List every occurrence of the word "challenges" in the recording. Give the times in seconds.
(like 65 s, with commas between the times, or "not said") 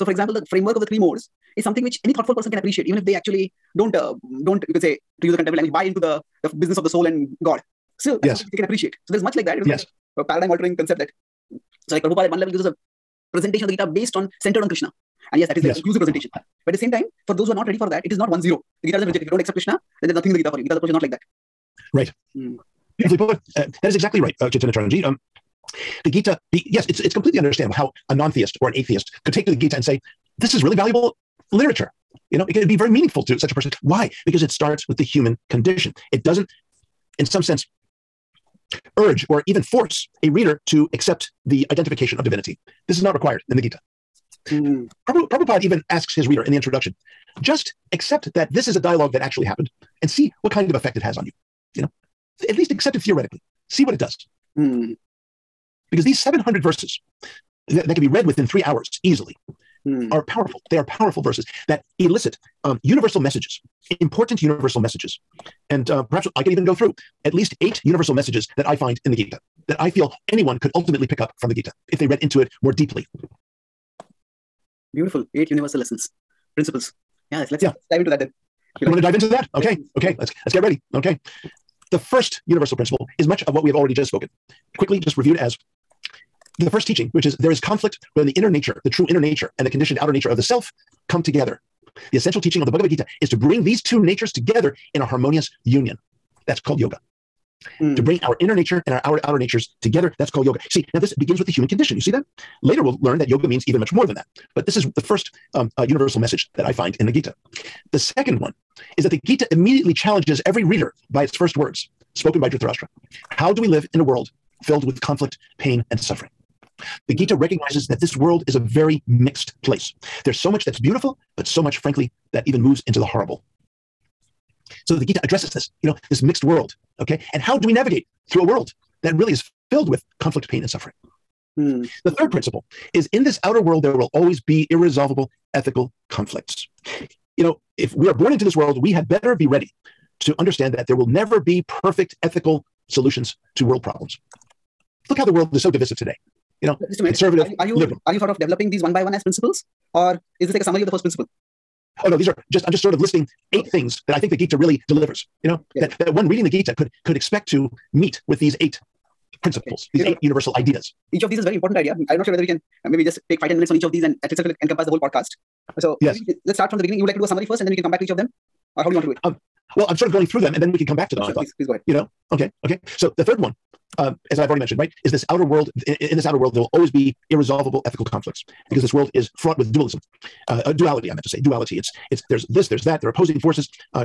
109 s.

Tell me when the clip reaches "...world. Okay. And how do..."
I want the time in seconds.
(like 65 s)
126 s.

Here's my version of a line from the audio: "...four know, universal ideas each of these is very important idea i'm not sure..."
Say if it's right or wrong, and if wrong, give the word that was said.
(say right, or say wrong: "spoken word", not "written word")
wrong: "eight", not "four".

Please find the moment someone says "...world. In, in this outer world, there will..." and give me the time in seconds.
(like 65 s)
175 s.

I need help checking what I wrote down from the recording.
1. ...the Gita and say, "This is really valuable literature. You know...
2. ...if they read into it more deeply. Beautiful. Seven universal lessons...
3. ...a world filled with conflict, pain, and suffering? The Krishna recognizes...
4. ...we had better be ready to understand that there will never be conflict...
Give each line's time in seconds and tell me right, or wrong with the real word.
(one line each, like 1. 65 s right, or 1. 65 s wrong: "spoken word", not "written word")
1. 29 s right
2. 71 s wrong: "Eight", not "Seven"
3. 113 s wrong: "Gita", not "Krishna"
4. 138 s wrong: "perfect", not "conflict".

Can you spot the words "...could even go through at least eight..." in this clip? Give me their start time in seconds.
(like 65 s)
66 s.